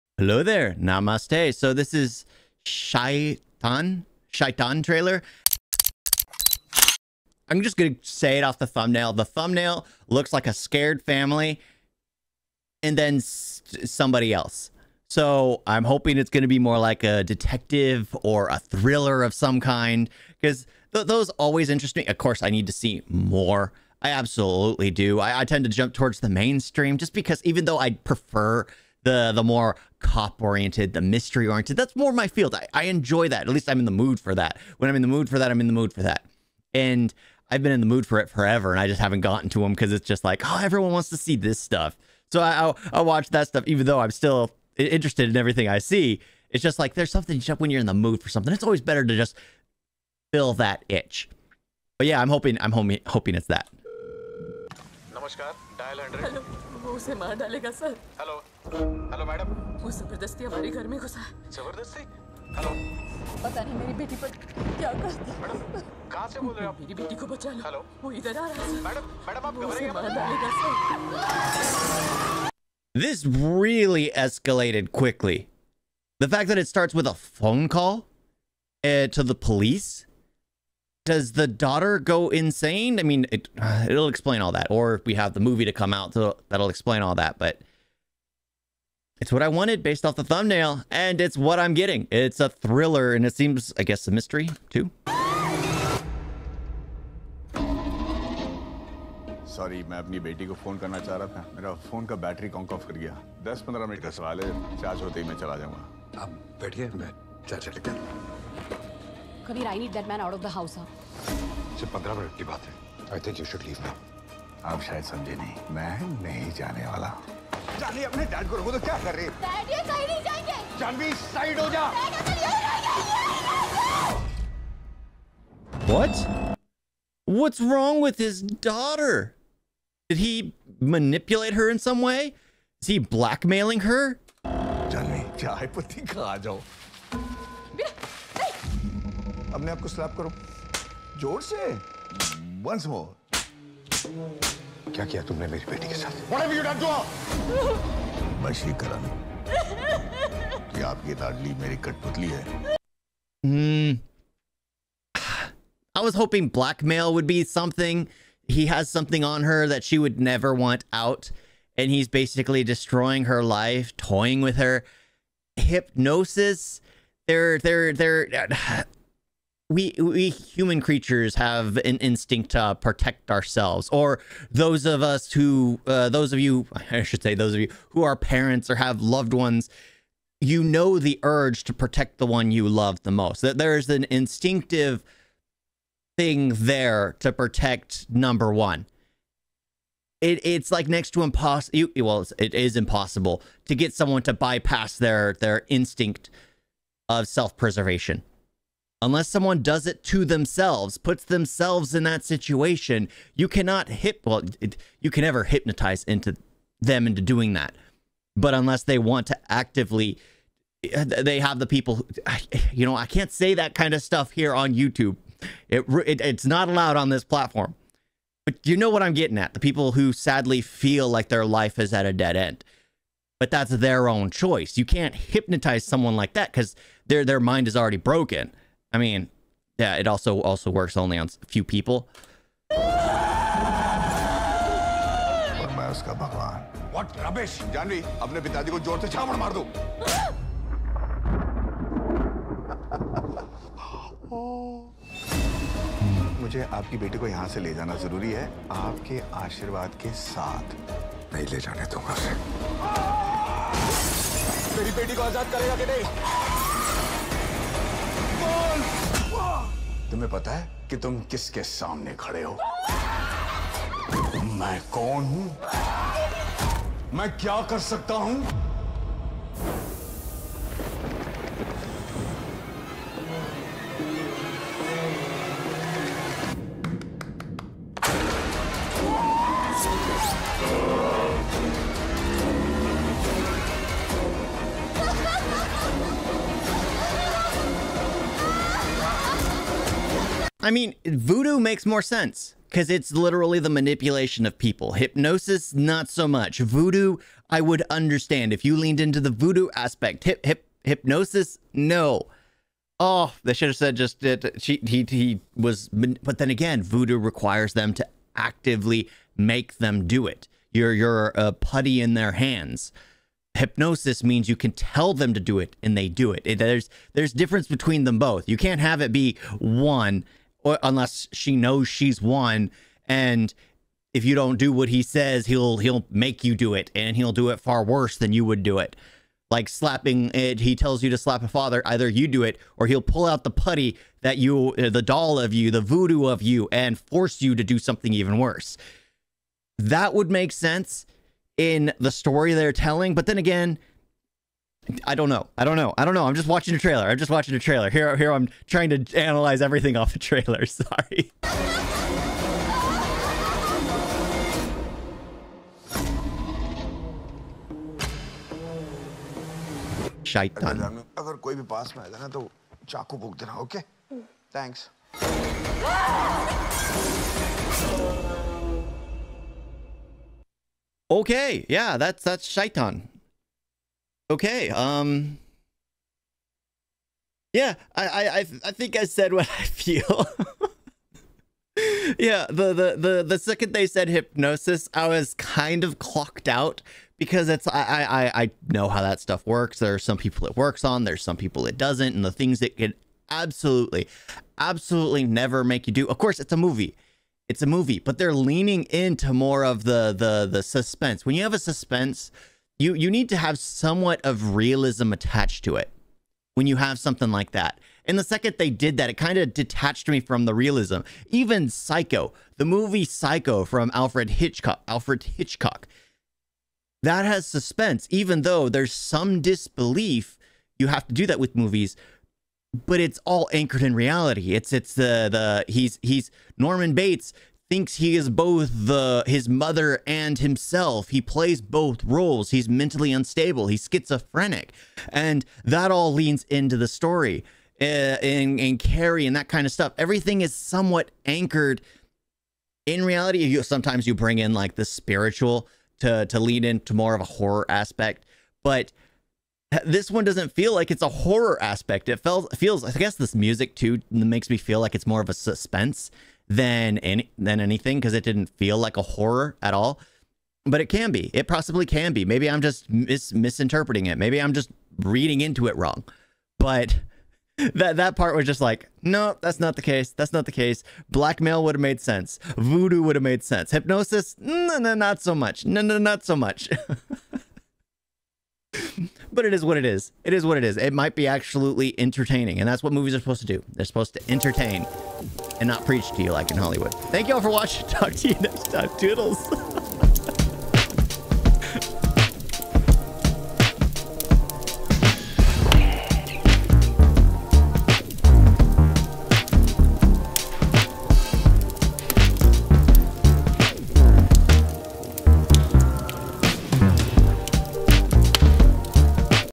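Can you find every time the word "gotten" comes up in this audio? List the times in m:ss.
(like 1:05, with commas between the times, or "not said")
0:39.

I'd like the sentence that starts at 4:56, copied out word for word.
Voodoo, I would understand if you leaned into the voodoo aspect.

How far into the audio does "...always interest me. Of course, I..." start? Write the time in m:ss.
0:21.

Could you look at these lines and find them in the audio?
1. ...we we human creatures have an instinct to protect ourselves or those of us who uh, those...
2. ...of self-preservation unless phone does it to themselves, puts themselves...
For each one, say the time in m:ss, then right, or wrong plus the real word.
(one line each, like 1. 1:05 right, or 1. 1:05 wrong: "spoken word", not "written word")
1. 2:49 right
2. 3:17 wrong: "someone", not "phone".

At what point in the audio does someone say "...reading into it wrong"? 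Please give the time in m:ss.
7:44.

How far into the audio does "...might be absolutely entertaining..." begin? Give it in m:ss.
8:00.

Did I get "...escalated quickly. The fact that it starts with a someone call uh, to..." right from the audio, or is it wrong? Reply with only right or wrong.
wrong.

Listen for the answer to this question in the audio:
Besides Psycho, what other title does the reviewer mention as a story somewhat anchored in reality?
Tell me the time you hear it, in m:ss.
7:18.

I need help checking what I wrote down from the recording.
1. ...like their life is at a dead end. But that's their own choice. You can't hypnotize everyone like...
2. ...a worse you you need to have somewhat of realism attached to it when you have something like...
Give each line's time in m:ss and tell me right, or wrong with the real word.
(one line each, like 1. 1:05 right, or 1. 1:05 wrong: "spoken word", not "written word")
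1. 3:41 wrong: "someone", not "everyone"
2. 6:41 wrong: "suspense", not "worse".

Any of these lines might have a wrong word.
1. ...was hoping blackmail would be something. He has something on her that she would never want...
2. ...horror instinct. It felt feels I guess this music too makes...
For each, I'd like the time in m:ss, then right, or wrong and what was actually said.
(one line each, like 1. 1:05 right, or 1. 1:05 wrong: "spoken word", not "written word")
1. 2:36 right
2. 7:31 wrong: "aspect", not "instinct".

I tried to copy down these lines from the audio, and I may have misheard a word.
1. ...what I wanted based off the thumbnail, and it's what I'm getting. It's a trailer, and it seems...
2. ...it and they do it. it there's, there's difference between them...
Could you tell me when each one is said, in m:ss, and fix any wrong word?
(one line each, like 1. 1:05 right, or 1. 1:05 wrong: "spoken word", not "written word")
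1. 1:29 wrong: "thriller", not "trailer"
2. 5:15 right.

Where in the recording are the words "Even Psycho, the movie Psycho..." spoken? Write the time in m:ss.
6:51.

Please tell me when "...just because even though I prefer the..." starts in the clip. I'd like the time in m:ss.
0:26.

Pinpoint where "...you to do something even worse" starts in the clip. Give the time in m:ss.
5:37.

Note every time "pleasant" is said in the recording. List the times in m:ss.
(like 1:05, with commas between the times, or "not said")
not said.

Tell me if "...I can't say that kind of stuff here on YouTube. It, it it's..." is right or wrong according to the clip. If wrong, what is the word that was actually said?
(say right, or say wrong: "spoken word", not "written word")
right.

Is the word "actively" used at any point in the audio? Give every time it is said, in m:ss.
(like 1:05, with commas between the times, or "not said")
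3:29, 5:08.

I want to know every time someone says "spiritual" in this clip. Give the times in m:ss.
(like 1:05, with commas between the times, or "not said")
7:24.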